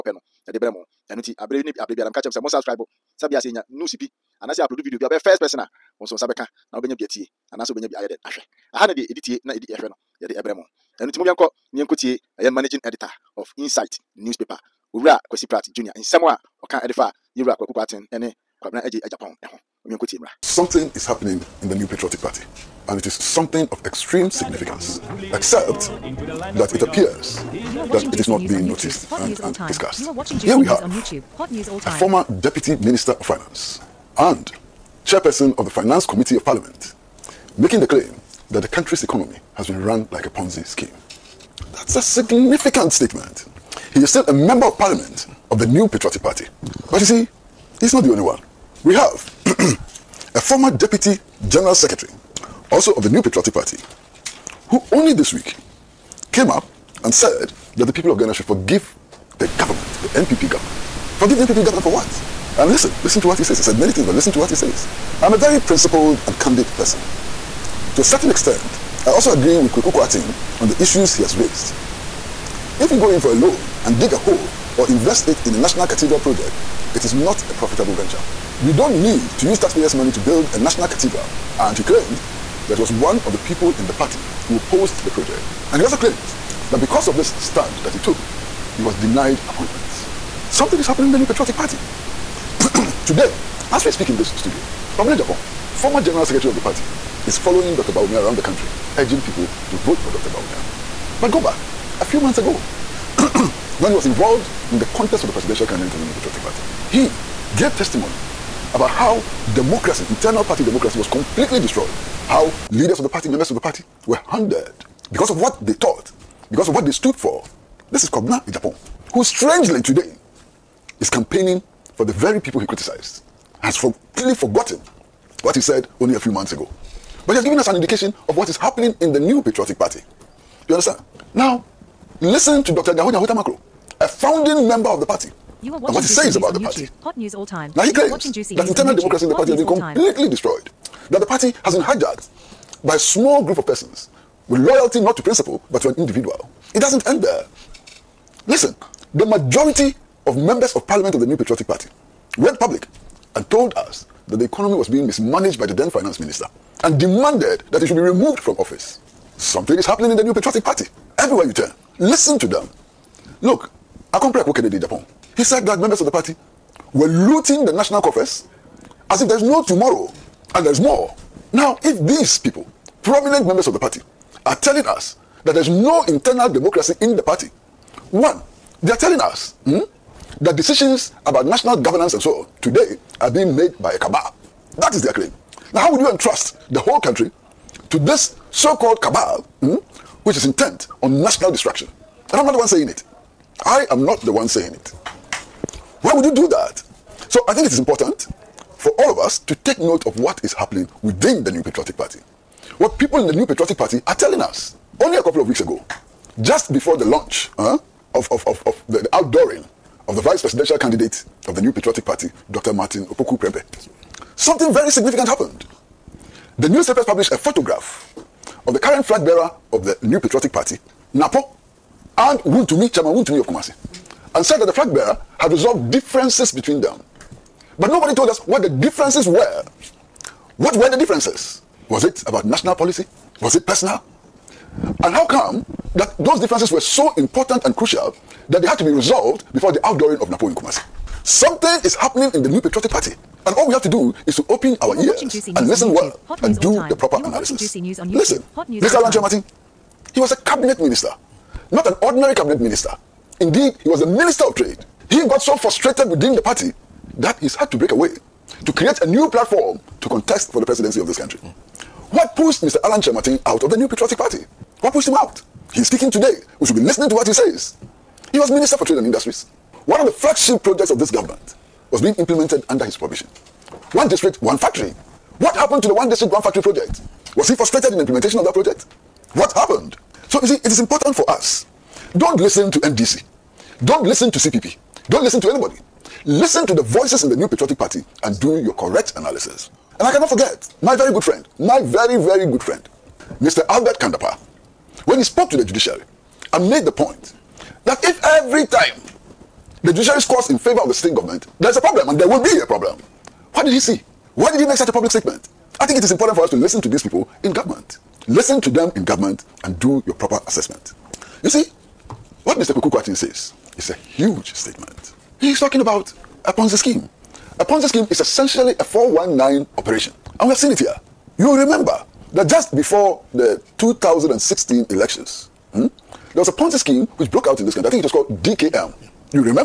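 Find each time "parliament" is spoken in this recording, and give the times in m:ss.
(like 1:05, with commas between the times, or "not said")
0:36, 0:44, 2:30.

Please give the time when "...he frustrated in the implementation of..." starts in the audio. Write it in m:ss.
4:37.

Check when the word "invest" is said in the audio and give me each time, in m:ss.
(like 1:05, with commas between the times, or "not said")
1:14.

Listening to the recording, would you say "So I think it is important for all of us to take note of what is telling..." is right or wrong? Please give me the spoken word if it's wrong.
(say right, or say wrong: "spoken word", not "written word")
wrong: "happening", not "telling".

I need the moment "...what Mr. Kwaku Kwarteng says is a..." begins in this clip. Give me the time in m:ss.
5:12.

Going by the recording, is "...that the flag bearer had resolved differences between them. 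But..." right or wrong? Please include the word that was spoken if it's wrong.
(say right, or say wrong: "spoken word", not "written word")
right.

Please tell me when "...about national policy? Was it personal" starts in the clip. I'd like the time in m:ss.
3:52.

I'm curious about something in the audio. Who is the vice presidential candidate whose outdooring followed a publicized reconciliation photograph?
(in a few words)
Dr. Martin Opoku Prempeh.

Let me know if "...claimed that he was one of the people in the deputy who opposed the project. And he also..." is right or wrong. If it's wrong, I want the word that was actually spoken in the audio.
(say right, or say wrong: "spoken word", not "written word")
wrong: "party", not "deputy".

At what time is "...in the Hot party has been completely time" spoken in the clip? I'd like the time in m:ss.
2:19.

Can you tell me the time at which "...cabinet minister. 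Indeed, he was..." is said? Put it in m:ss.
4:12.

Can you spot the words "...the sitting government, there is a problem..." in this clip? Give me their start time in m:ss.
5:00.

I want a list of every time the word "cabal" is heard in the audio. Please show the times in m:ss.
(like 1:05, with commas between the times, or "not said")
3:03, 3:09.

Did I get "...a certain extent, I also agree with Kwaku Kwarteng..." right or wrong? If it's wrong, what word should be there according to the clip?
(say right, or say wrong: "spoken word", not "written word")
right.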